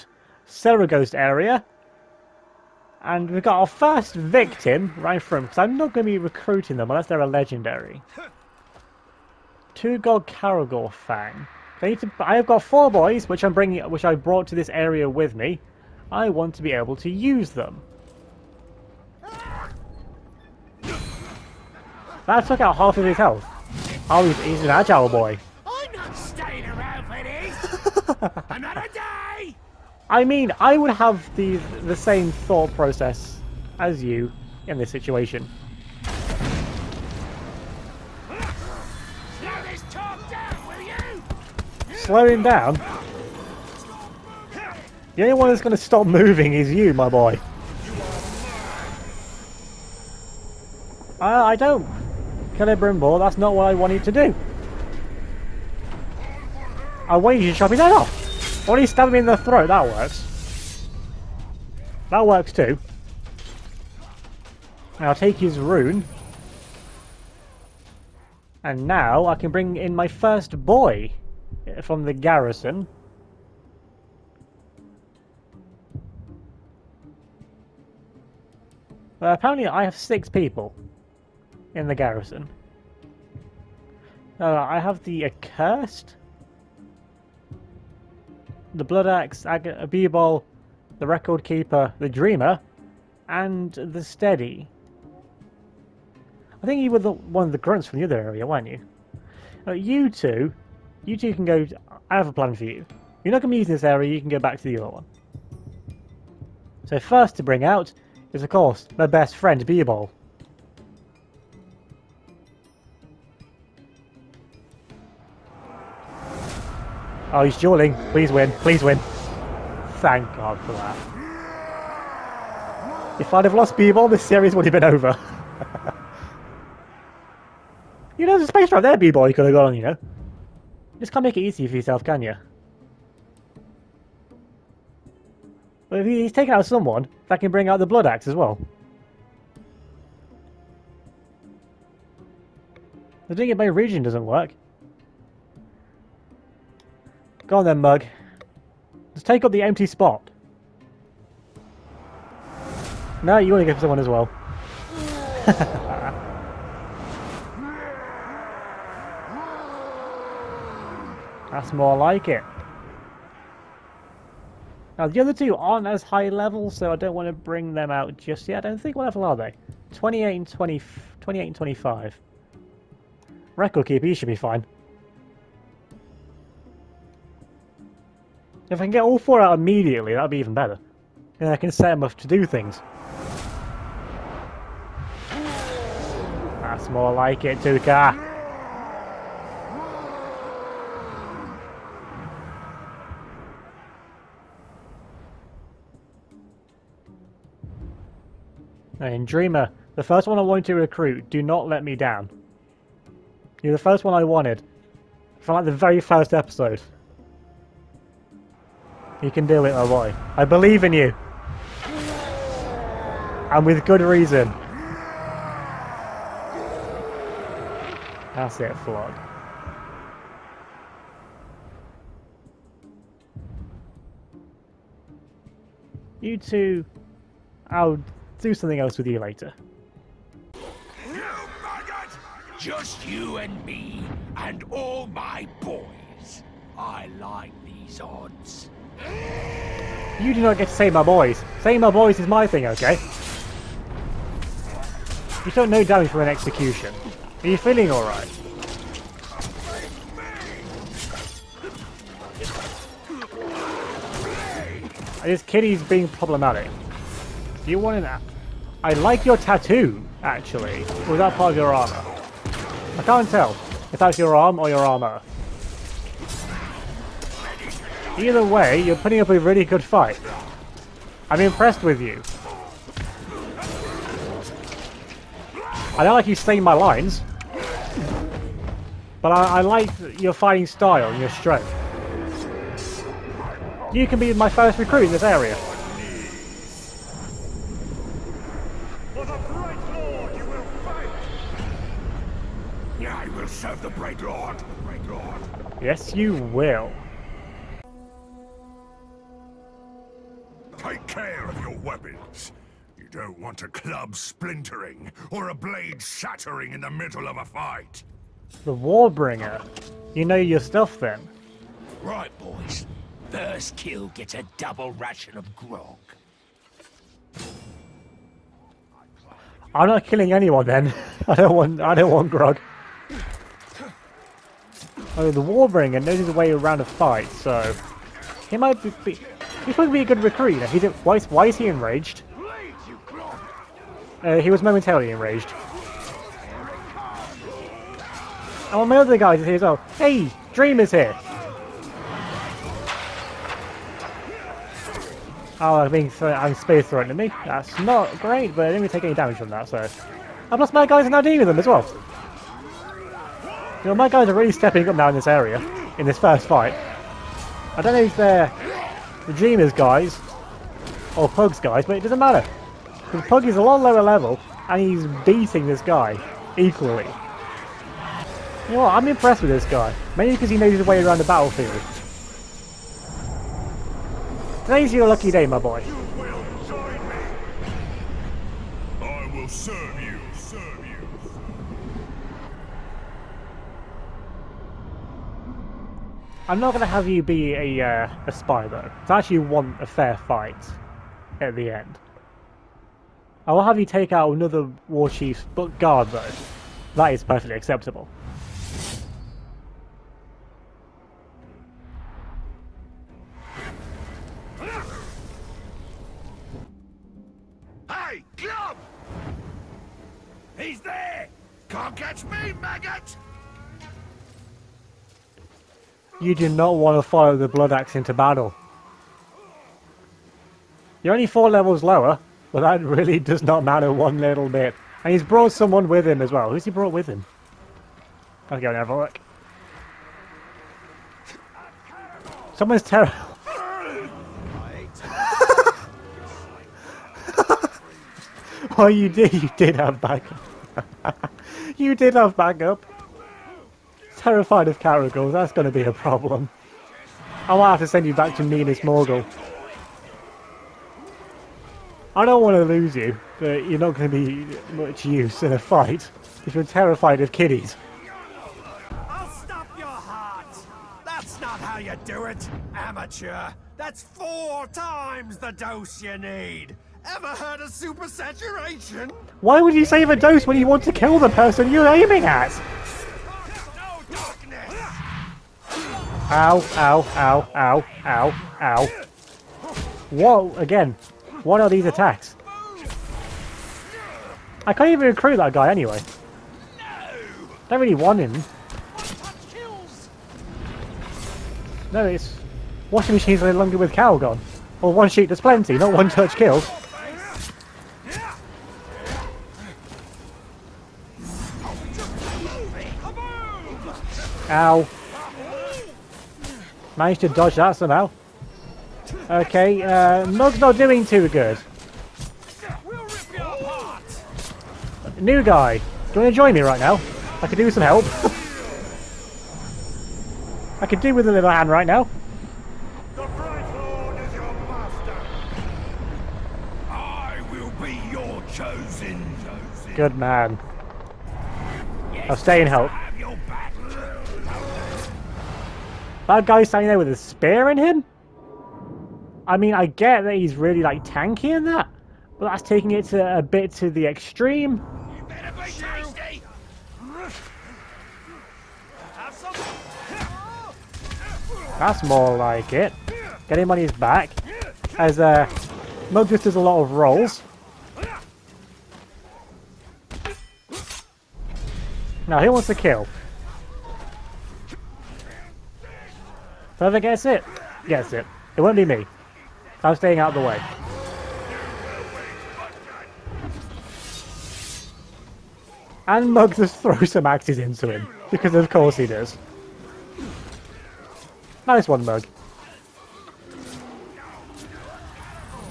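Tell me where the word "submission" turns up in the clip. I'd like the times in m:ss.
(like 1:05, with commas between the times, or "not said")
not said.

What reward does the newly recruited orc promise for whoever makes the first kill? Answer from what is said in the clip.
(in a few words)
double ration of grog.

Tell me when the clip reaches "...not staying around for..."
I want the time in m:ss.
0:25.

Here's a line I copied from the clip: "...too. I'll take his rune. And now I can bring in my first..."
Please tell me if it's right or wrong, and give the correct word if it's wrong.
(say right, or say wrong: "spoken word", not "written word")
right.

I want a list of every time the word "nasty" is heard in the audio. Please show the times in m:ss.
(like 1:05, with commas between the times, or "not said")
not said.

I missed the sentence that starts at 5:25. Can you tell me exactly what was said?
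Oh, the Warbringer knows his way around a fight, so he might be, be He's to be a good recruit, you know.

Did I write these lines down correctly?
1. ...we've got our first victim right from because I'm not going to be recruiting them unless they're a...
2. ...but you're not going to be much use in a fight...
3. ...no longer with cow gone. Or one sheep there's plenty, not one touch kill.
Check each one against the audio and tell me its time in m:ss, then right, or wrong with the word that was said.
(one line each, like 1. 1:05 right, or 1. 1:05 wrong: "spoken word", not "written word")
1. 0:03 right
2. 7:33 right
3. 8:13 right.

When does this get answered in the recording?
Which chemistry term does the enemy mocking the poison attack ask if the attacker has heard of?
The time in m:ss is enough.
7:47.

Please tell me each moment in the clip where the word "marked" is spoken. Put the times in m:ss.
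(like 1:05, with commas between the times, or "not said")
not said.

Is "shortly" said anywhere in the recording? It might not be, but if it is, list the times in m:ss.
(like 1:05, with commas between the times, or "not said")
not said.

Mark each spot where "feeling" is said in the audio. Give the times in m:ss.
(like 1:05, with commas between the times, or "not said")
4:07.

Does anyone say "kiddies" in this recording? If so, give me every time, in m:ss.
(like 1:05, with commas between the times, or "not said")
7:37.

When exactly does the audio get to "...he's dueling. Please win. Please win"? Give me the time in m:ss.
1:57.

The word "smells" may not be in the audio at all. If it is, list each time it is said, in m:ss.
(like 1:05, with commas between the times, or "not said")
not said.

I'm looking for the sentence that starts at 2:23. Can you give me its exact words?
The thing about region doesn't work.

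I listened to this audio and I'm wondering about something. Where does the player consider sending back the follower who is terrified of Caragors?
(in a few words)
Minas Morgul.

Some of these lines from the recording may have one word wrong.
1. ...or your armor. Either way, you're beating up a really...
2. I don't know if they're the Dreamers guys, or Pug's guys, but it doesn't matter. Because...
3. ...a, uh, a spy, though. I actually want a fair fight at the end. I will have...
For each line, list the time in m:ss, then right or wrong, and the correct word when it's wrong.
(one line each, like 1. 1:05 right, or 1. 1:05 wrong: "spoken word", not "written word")
1. 4:24 wrong: "putting", not "beating"
2. 5:57 right
3. 6:27 right.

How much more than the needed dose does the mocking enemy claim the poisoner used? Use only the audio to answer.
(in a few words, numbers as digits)
four times.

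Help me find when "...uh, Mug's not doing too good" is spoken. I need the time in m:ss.
8:29.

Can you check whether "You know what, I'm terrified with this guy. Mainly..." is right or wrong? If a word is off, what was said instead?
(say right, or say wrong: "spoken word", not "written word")
wrong: "impressed", not "terrified".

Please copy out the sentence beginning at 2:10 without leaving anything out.
You just can't make it easy for yourself, can you?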